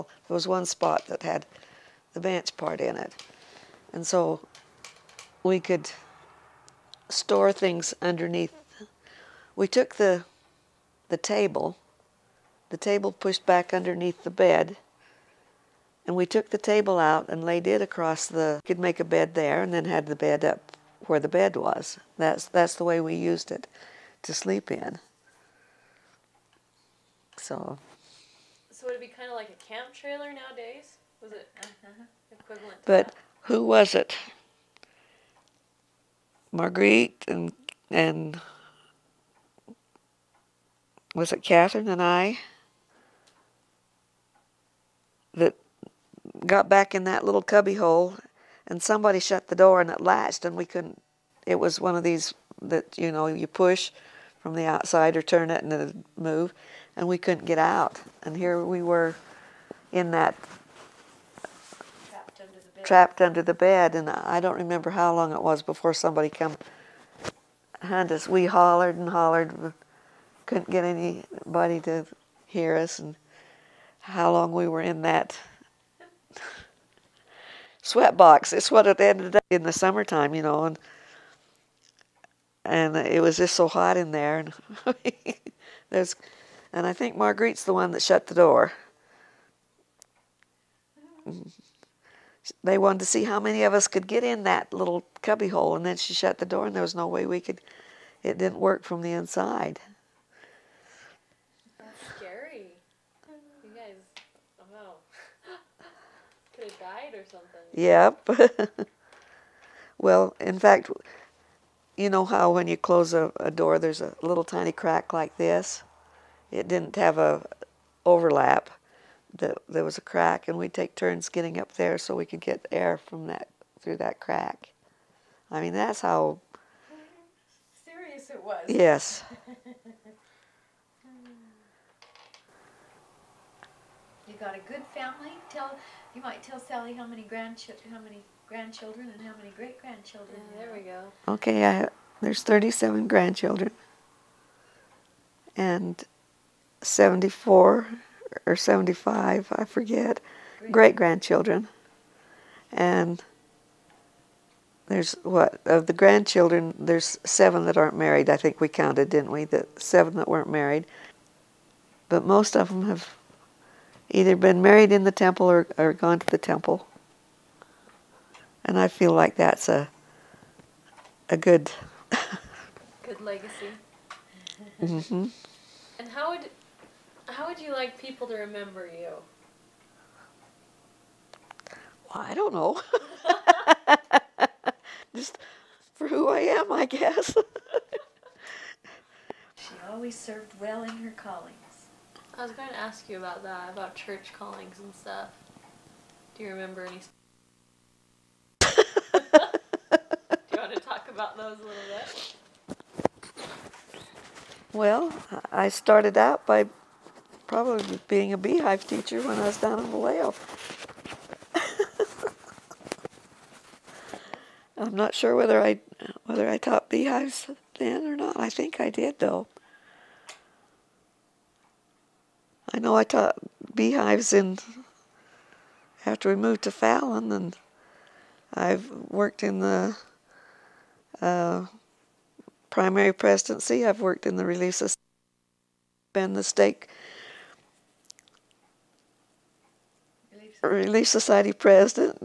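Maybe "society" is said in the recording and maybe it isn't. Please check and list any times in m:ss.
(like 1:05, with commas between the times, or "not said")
3:54, 4:01.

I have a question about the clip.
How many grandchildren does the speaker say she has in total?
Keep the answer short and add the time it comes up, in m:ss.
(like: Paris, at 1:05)
37, at 2:22.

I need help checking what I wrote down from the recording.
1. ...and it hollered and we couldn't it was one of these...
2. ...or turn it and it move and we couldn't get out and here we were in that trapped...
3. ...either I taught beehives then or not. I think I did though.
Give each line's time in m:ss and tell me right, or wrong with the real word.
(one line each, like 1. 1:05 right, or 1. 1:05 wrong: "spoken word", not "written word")
1. 0:49 wrong: "latched", not "hollered"
2. 0:55 right
3. 3:36 wrong: "whether", not "either".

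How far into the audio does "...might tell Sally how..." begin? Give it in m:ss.
2:16.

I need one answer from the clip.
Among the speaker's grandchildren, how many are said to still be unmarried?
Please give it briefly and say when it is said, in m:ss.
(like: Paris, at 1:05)
7, at 2:36.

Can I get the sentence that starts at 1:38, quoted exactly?
It didn't work from the inside.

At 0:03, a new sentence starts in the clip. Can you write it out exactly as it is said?
And so we could store things underneath.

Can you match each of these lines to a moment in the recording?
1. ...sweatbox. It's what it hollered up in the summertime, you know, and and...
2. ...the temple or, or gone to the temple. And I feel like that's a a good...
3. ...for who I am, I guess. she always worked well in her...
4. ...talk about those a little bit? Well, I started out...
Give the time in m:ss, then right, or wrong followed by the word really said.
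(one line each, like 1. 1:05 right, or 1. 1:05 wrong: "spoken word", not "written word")
1. 1:17 wrong: "ended", not "hollered"
2. 2:45 right
3. 3:05 wrong: "served", not "worked"
4. 3:20 right.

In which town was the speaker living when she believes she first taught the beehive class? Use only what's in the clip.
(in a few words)
Vallejo.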